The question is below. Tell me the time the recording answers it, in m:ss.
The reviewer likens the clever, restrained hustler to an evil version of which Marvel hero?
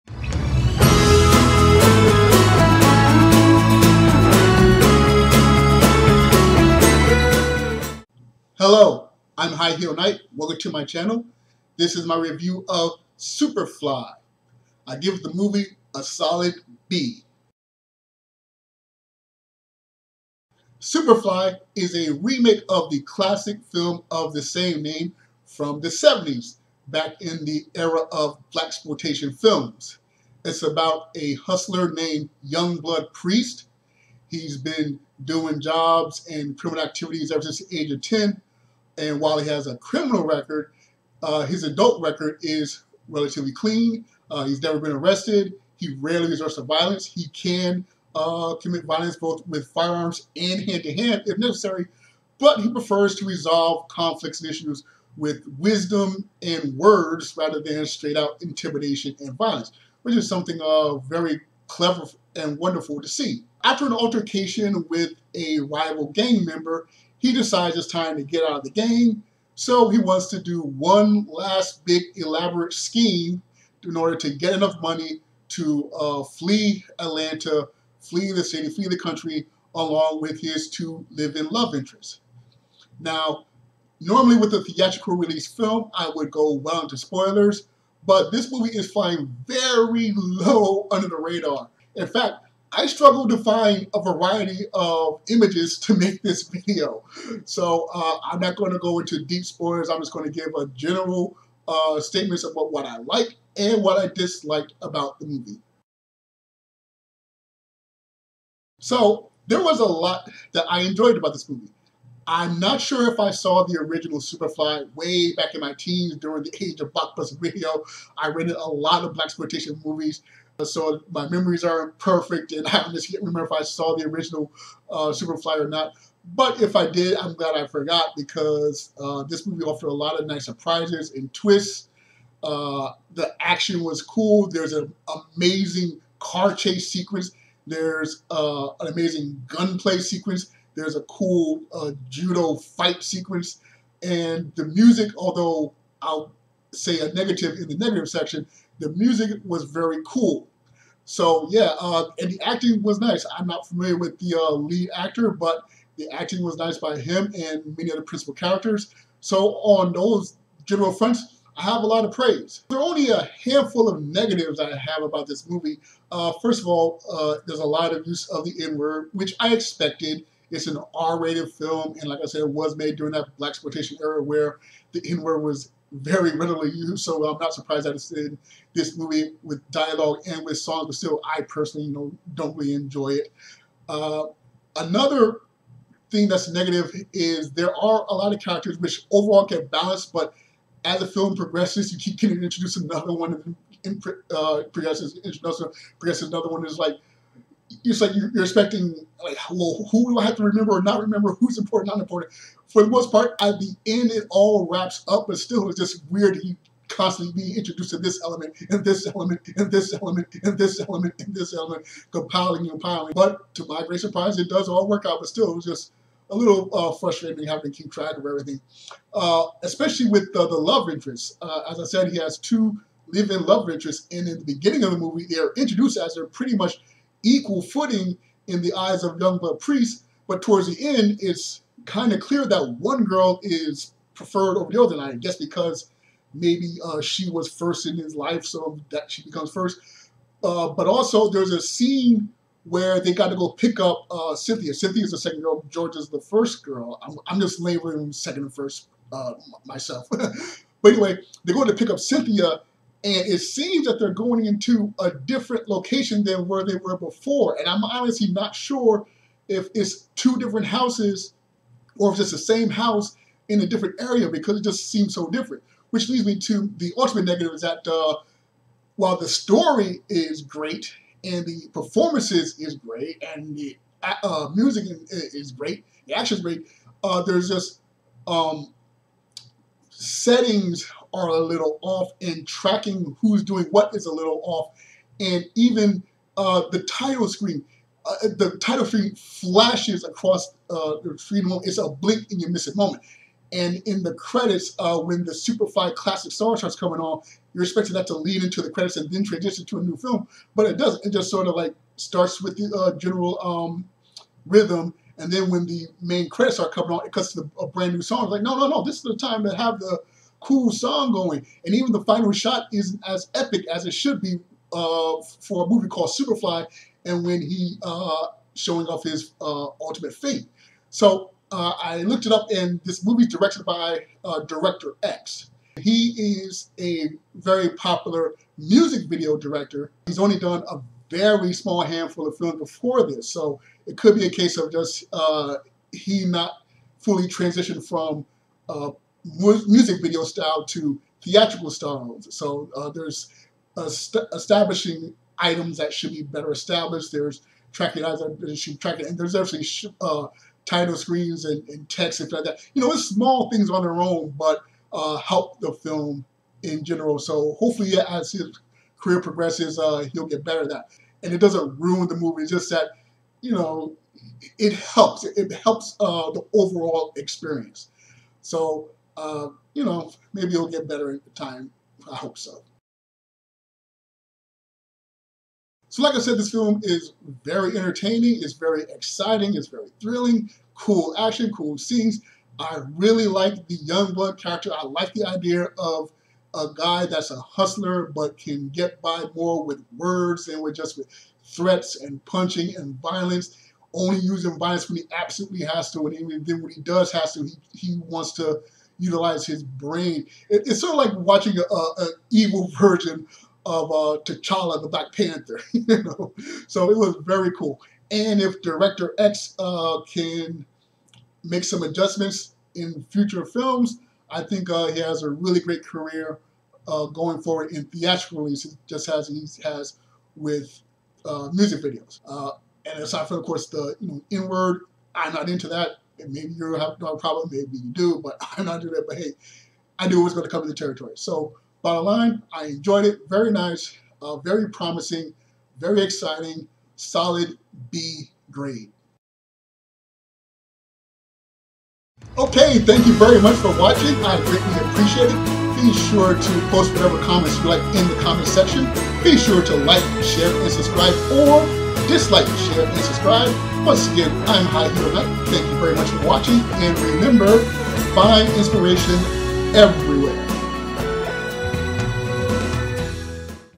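6:44.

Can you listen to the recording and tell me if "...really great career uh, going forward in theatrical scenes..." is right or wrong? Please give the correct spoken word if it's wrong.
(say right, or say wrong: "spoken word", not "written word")
wrong: "releases", not "scenes".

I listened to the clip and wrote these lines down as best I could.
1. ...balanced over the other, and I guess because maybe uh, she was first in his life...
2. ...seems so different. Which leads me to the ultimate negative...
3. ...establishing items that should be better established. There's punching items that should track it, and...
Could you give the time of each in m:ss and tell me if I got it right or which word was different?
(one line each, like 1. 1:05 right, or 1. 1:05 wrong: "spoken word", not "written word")
1. 3:54 wrong: "preferred", not "balanced"
2. 4:24 right
3. 5:43 wrong: "tracking", not "punching".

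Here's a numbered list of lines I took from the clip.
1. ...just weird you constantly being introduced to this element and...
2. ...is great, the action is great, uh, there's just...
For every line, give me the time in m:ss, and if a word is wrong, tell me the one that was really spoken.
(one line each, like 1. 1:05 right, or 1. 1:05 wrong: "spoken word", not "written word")
1. 3:25 right
2. 4:35 right.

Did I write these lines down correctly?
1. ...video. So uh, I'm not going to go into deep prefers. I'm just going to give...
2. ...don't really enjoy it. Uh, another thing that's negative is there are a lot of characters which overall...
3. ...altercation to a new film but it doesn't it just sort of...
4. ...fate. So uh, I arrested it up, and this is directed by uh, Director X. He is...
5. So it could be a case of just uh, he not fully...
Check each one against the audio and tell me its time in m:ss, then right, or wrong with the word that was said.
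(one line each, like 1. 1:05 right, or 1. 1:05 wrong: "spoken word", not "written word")
1. 1:36 wrong: "spoilers", not "prefers"
2. 3:02 right
3. 4:59 wrong: "transition", not "altercation"
4. 5:20 wrong: "looked", not "arrested"
5. 5:33 right.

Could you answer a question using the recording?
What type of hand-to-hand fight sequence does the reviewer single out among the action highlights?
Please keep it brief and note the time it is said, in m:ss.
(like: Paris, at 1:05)
Judo, at 2:22.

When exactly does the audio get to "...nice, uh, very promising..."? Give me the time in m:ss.
7:13.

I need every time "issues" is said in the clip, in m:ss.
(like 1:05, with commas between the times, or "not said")
0:54.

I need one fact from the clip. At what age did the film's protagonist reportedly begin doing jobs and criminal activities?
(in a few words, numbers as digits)
10.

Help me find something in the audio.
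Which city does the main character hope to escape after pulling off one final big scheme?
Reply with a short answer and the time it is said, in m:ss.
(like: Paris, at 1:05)
Atlanta, at 1:16.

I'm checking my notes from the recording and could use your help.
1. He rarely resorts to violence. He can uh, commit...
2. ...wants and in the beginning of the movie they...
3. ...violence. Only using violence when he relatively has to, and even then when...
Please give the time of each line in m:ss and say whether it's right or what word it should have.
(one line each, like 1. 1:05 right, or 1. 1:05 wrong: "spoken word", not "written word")
1. 0:45 right
2. 3:43 wrong: "interests", not "wants"
3. 6:33 wrong: "absolutely", not "relatively".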